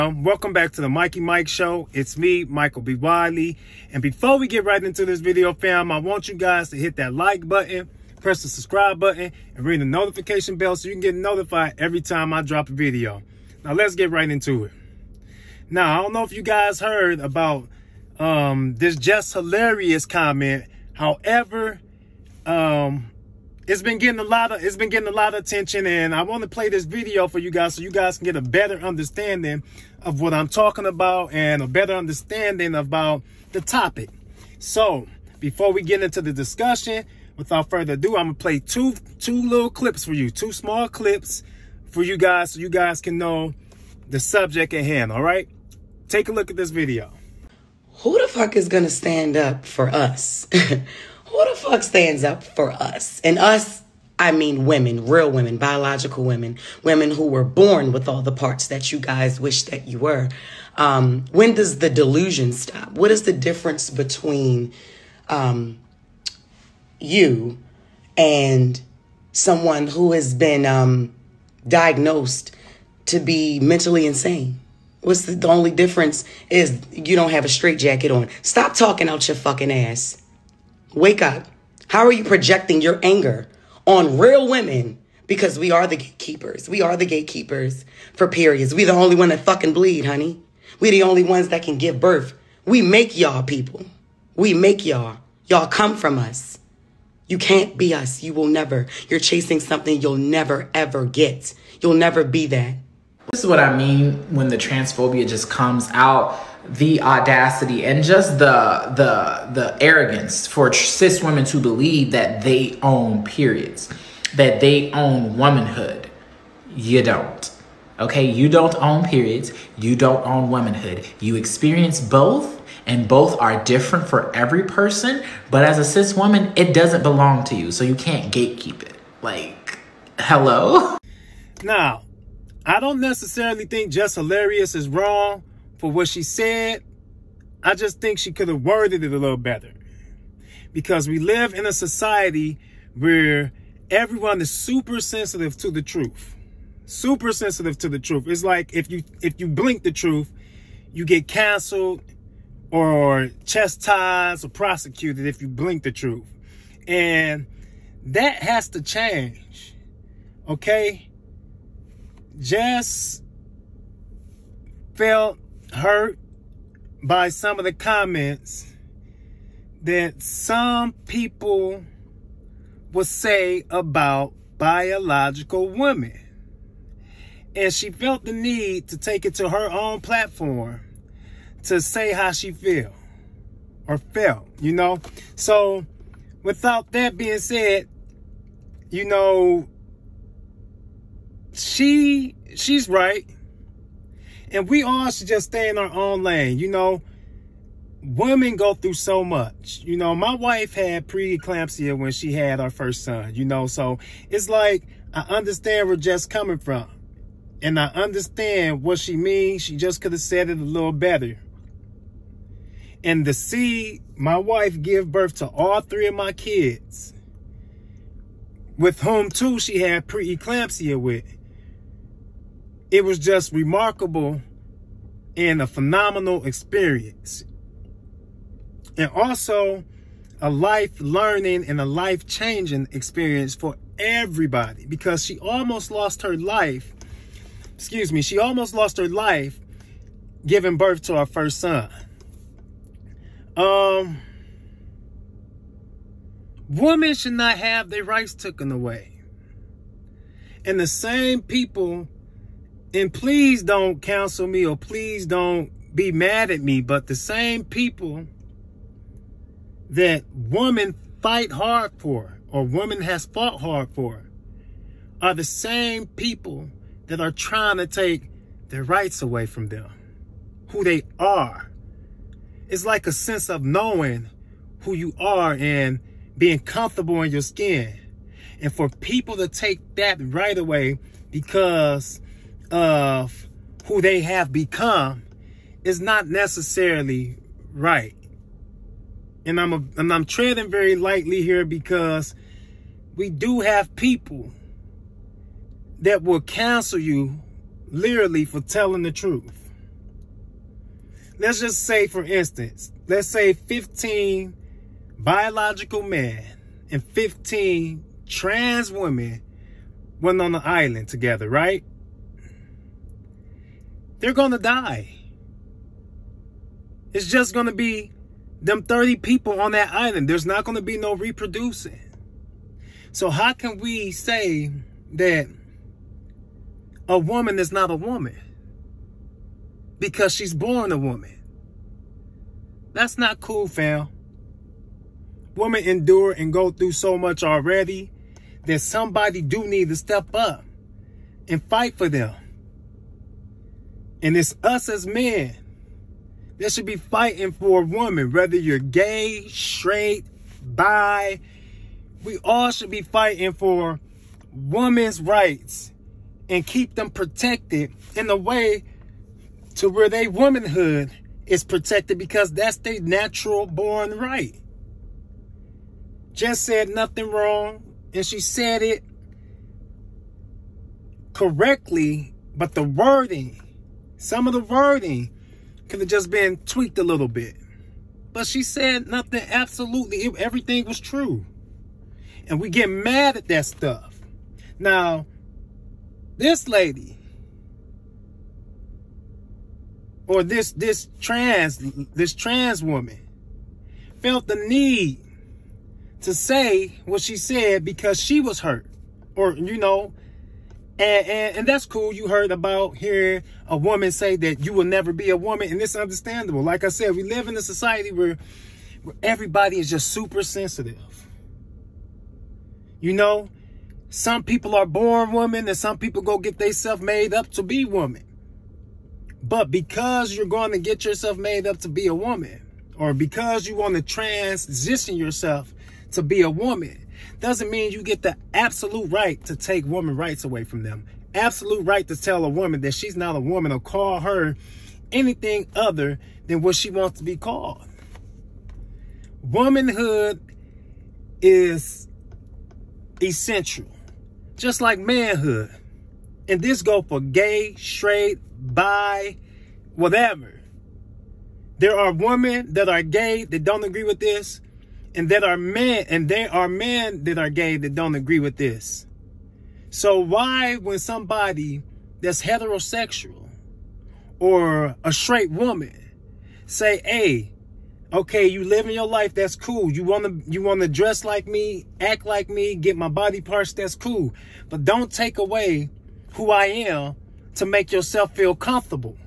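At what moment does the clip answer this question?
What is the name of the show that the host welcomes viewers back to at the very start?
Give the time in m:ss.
0:00.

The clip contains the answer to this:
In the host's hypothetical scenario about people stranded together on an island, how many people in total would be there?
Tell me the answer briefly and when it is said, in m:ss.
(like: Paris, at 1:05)
30, at 5:18.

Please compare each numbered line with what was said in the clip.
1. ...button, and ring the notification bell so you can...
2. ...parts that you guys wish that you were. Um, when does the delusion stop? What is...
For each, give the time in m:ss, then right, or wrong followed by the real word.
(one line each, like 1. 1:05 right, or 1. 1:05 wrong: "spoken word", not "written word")
1. 0:08 right
2. 0:58 right.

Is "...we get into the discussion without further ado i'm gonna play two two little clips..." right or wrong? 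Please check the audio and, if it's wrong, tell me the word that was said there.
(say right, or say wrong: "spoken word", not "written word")
right.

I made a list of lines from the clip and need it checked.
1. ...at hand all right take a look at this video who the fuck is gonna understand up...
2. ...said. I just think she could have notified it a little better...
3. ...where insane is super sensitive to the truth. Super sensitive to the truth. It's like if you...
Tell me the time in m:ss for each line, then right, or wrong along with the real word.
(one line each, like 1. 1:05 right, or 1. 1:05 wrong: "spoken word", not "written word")
1. 0:44 wrong: "stand", not "understand"
2. 2:16 wrong: "worded", not "notified"
3. 2:22 wrong: "everyone", not "insane".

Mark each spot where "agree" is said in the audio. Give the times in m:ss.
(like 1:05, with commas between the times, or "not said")
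7:33, 7:38.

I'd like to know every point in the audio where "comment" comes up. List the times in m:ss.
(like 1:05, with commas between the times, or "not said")
0:20, 2:47.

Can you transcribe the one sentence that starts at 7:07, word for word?
Doesn't mean you get the absolute right to take woman rights away from them.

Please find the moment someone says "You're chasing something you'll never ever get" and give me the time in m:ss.
1:39.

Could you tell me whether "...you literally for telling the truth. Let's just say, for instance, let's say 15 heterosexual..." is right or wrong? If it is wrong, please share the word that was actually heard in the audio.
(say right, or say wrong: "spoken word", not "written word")
wrong: "biological", not "heterosexual".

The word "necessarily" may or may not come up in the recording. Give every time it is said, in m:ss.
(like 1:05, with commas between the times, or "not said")
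2:12, 4:46.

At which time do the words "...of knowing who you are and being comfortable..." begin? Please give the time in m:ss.
4:33.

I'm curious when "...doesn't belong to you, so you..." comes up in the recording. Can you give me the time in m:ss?
2:06.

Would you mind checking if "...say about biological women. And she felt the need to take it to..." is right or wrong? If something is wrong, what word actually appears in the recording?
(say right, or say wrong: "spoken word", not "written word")
right.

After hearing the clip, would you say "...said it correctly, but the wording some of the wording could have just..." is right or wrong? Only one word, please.
right.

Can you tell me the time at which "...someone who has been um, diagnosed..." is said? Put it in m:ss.
1:09.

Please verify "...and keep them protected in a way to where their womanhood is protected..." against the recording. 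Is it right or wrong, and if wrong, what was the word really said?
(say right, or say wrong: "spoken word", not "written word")
right.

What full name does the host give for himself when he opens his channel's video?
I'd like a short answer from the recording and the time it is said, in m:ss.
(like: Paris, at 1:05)
Michael B. Wiley, at 0:02.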